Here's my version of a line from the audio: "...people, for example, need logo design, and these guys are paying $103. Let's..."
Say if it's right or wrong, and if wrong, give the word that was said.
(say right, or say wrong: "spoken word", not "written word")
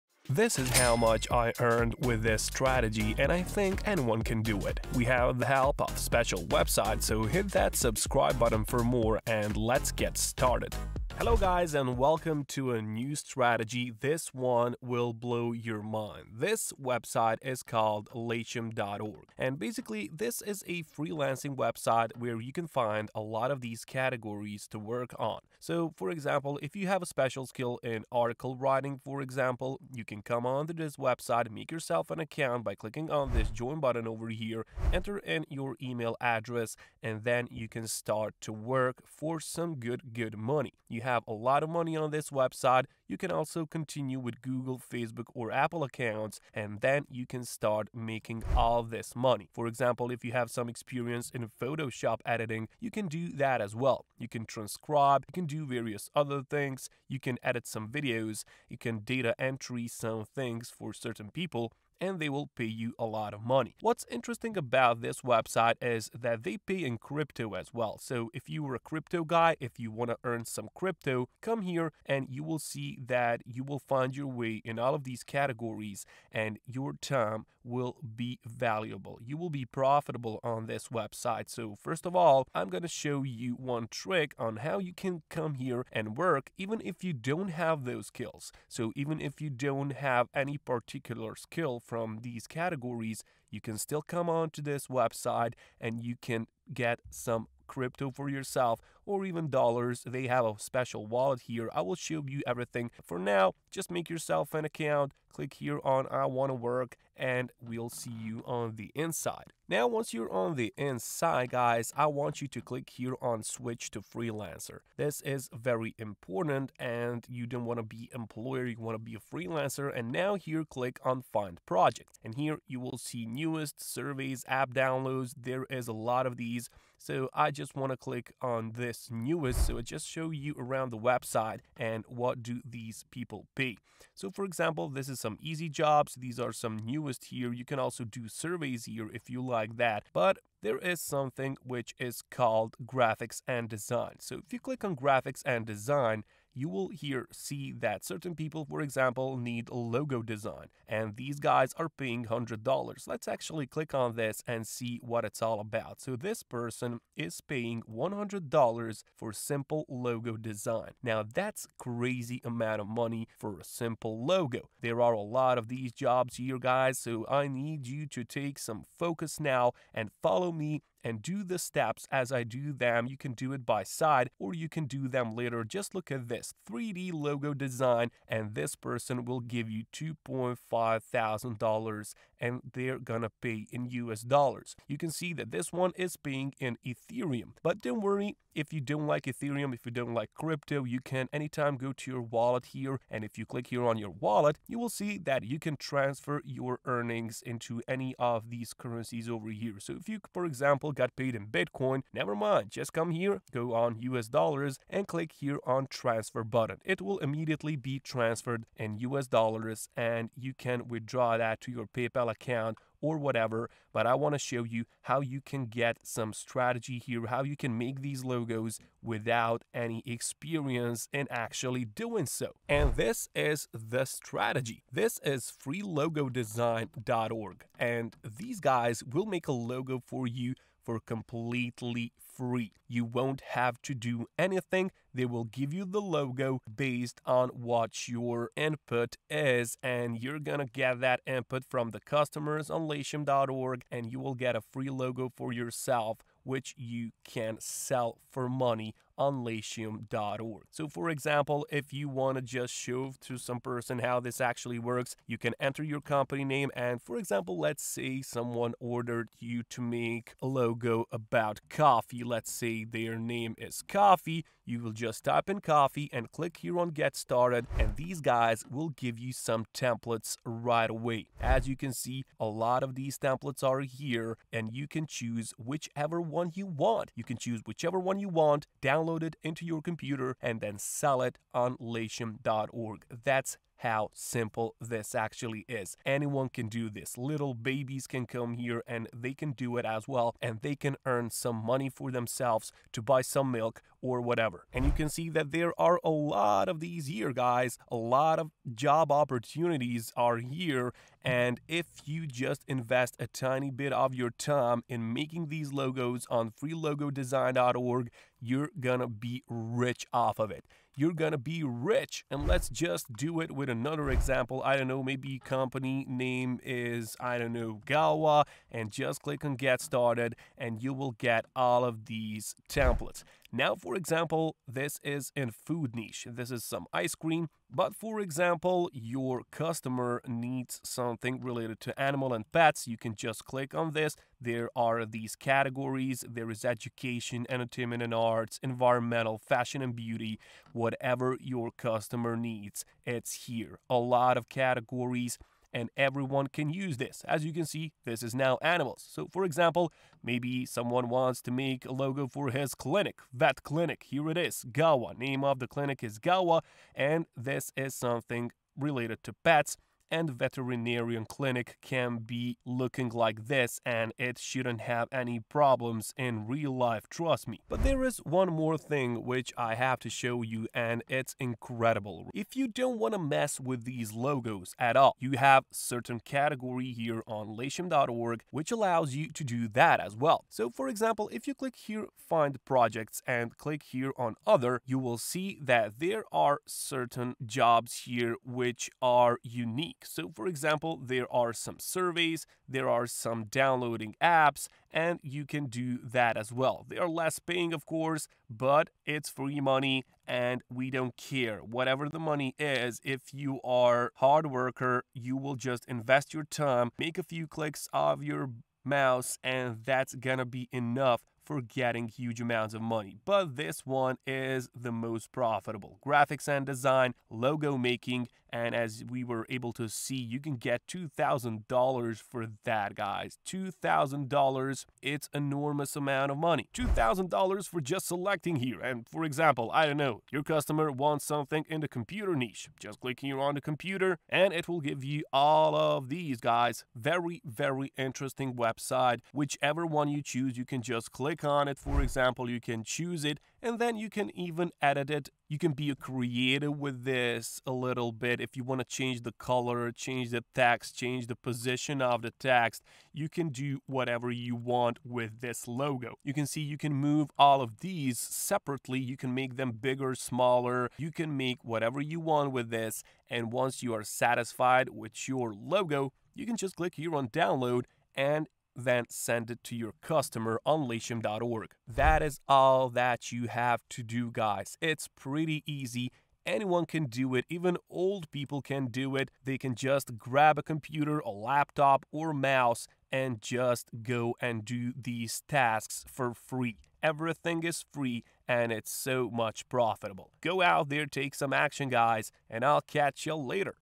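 wrong: "100", not "103".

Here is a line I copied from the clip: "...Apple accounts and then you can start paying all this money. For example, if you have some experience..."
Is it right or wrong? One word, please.
wrong.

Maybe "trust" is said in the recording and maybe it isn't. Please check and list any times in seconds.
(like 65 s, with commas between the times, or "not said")
367 s.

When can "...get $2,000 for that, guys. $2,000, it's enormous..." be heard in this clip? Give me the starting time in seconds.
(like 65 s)
420 s.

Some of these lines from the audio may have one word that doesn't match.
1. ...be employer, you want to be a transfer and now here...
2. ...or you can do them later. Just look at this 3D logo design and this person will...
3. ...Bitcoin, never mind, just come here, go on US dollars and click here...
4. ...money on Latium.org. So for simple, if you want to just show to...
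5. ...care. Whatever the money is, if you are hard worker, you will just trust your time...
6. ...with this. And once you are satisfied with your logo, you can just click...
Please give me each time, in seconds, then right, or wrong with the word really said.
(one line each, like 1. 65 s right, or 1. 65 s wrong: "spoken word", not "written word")
1. 117 s wrong: "freelancer", not "transfer"
2. 174 s right
3. 201 s right
4. 248 s wrong: "example", not "simple"
5. 401 s wrong: "invest", not "trust"
6. 462 s right.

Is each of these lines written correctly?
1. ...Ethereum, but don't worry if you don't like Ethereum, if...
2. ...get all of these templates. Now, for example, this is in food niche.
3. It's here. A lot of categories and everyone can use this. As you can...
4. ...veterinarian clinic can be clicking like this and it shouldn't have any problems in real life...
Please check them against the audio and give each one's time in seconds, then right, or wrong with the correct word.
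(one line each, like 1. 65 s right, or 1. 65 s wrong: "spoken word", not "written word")
1. 186 s right
2. 321 s right
3. 343 s right
4. 360 s wrong: "looking", not "clicking".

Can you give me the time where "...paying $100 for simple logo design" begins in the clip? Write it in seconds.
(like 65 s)
157 s.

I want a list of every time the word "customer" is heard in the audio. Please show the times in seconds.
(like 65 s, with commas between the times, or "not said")
241 s, 329 s, 341 s, 430 s, 470 s.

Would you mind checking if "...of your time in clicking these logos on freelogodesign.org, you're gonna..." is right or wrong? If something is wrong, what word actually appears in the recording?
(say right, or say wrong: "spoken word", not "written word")
wrong: "making", not "clicking".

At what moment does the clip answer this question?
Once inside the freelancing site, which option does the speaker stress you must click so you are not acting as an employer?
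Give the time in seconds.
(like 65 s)
113 s.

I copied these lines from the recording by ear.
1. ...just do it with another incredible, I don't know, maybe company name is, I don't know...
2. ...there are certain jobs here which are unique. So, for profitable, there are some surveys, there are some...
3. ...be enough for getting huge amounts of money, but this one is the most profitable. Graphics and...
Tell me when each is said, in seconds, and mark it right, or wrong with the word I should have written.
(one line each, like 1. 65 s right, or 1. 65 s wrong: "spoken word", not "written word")
1. 312 s wrong: "example", not "incredible"
2. 385 s wrong: "example", not "profitable"
3. 410 s right.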